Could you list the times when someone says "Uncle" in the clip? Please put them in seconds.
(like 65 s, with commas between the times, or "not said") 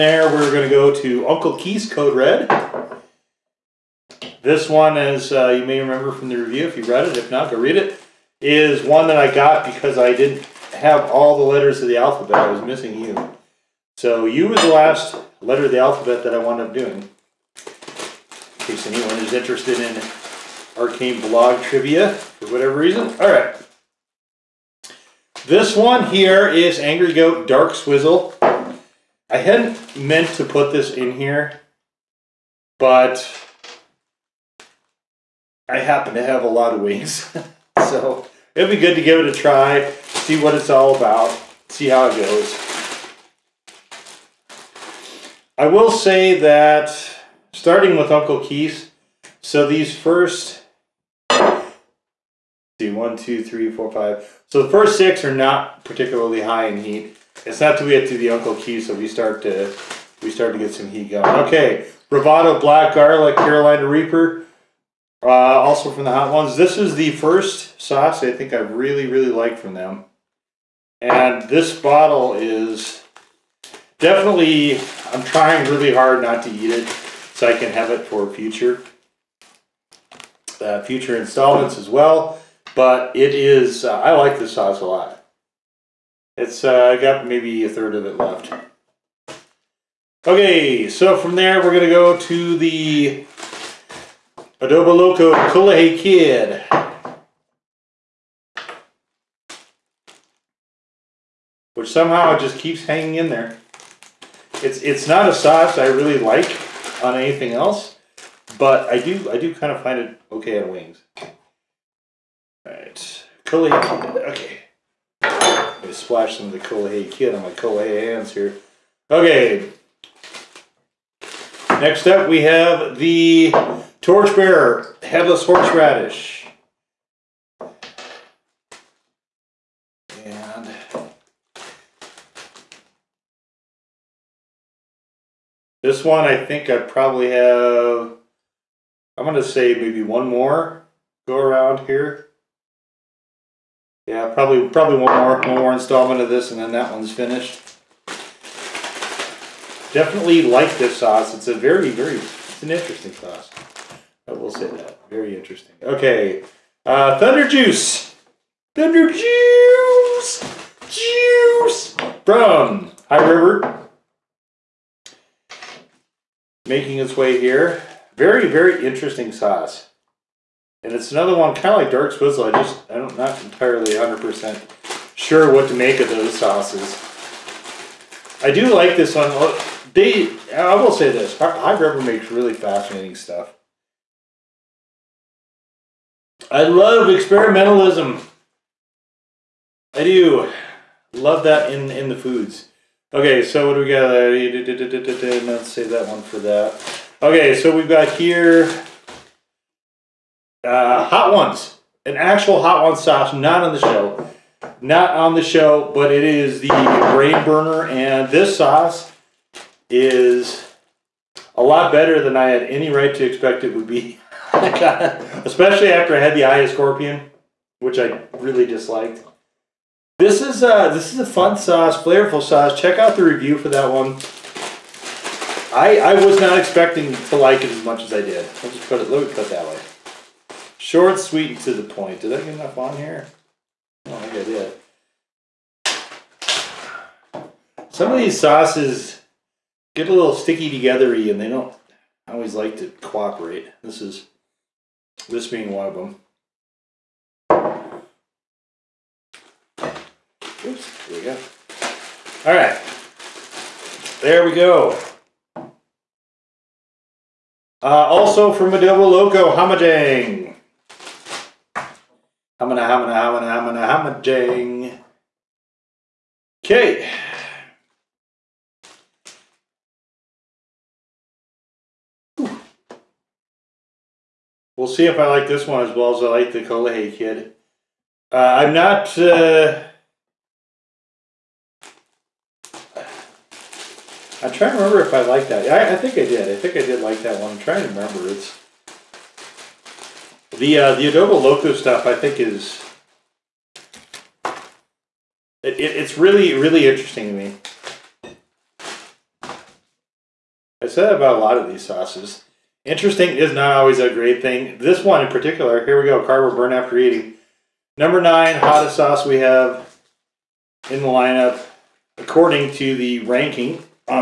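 1 s, 48 s, 58 s.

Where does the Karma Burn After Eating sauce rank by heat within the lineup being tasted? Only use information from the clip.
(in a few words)
9th hottest.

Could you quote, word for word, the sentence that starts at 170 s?
And it's another one, kind of like dark swizzle.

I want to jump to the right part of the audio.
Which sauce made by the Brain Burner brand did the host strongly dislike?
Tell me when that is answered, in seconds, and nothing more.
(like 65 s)
216 s.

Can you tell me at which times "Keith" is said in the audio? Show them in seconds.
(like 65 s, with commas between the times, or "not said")
1 s, 48 s.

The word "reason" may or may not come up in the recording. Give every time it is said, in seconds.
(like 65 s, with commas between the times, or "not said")
22 s.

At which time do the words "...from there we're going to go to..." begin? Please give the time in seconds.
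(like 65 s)
91 s.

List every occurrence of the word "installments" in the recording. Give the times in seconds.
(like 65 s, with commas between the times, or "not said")
81 s, 145 s.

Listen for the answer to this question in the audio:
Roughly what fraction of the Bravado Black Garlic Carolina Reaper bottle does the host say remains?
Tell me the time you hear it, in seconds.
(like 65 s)
87 s.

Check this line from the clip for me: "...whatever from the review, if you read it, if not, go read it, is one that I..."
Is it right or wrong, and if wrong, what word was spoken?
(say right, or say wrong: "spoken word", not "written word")
wrong: "remember", not "whatever".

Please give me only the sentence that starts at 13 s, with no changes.
So U was the last letter of the alphabet that I wound up doing.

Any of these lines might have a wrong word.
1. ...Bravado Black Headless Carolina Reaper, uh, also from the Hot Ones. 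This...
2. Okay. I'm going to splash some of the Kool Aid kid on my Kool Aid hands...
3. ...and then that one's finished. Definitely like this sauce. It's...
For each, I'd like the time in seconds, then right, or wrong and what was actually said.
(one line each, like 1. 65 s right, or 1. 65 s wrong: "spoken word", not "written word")
1. 62 s wrong: "Garlic", not "Headless"
2. 113 s right
3. 146 s right.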